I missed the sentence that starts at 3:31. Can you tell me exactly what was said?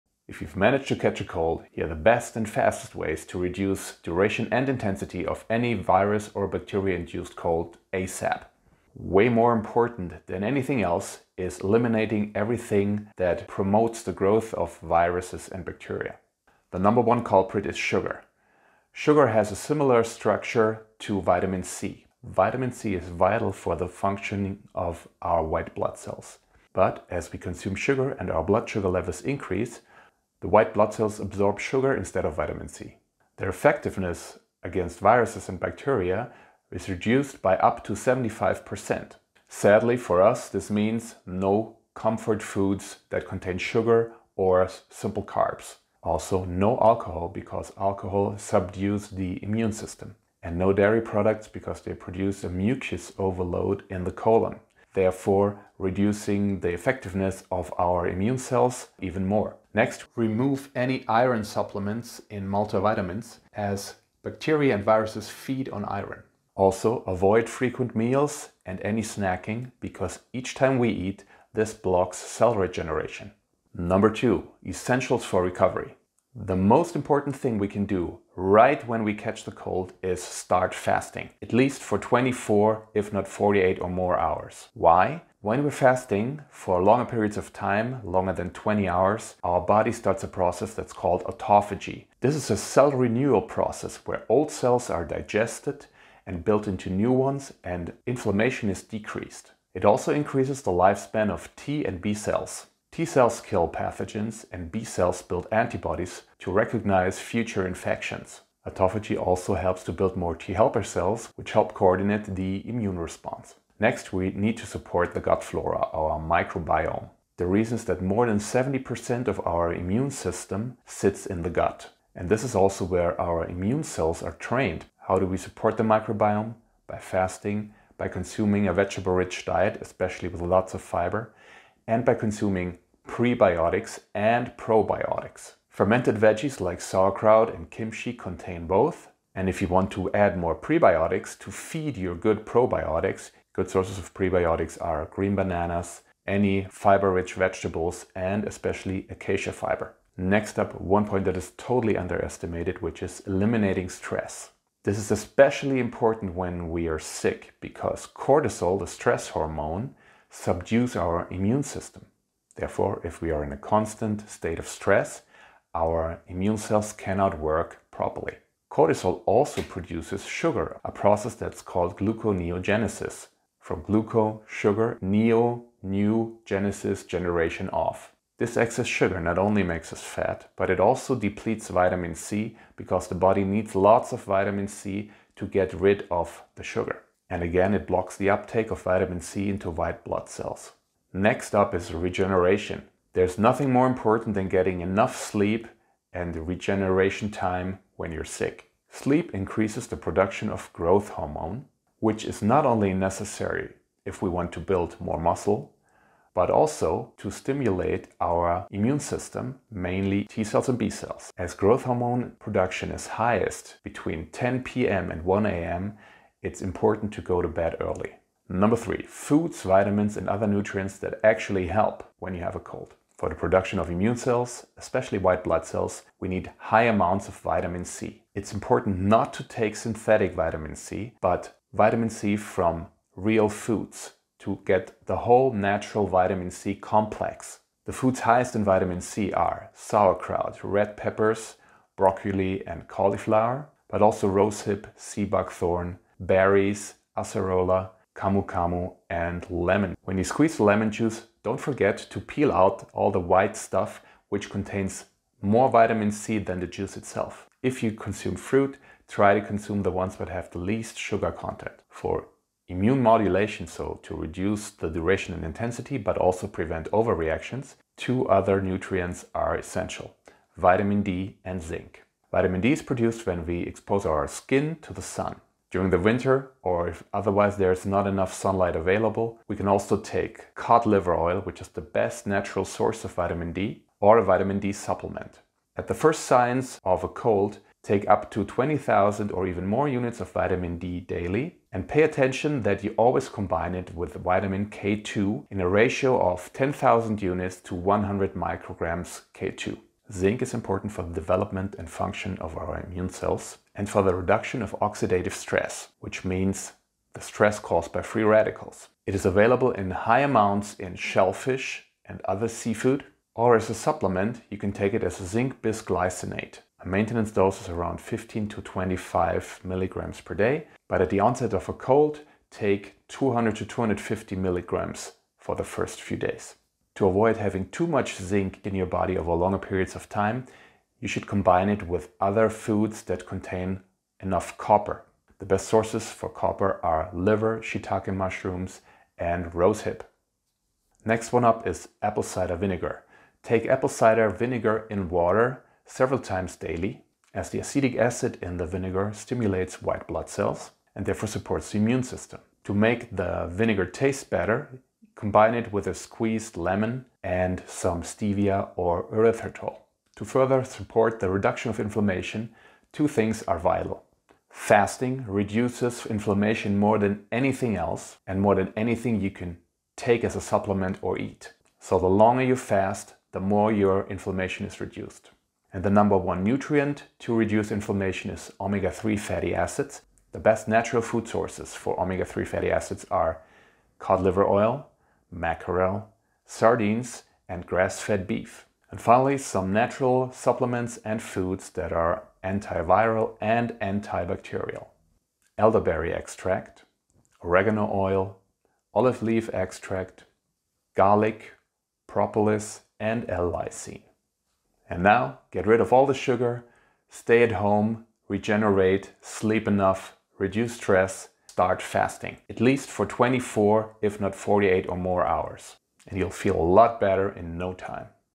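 As growth hormone production is highest between 10 p.m.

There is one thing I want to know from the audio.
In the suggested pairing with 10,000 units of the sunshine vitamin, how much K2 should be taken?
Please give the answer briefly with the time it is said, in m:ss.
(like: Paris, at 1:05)
100 micrograms, at 4:57.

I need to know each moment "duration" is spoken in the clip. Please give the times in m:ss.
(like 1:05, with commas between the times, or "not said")
0:04, 4:24.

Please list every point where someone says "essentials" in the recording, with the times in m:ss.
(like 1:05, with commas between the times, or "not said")
1:14, 4:29.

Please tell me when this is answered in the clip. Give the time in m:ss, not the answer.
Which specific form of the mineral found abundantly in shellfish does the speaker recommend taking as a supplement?
5:15.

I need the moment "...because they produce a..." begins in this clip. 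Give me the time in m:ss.
0:51.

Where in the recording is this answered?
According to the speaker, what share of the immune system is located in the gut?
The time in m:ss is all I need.
1:58.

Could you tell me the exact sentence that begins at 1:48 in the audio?
Autophagy also helps to build more T helper cells, which help coordinate the immune response.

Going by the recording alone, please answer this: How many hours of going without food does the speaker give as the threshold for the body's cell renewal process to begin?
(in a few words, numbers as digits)
20 hours.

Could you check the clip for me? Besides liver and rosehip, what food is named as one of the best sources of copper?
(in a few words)
shiitake mushrooms.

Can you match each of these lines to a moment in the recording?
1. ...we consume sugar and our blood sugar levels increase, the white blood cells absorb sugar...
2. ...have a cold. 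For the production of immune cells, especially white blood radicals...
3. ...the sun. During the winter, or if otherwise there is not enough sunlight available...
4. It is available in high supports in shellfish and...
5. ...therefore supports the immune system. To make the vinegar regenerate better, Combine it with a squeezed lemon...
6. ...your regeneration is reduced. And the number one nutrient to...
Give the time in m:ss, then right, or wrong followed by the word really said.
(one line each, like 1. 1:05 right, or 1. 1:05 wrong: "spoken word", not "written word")
1. 0:27 right
2. 3:42 wrong: "cells", not "radicals"
3. 4:34 right
4. 5:09 wrong: "amounts", not "supports"
5. 5:51 wrong: "taste", not "regenerate"
6. 6:13 wrong: "inflammation", not "regeneration".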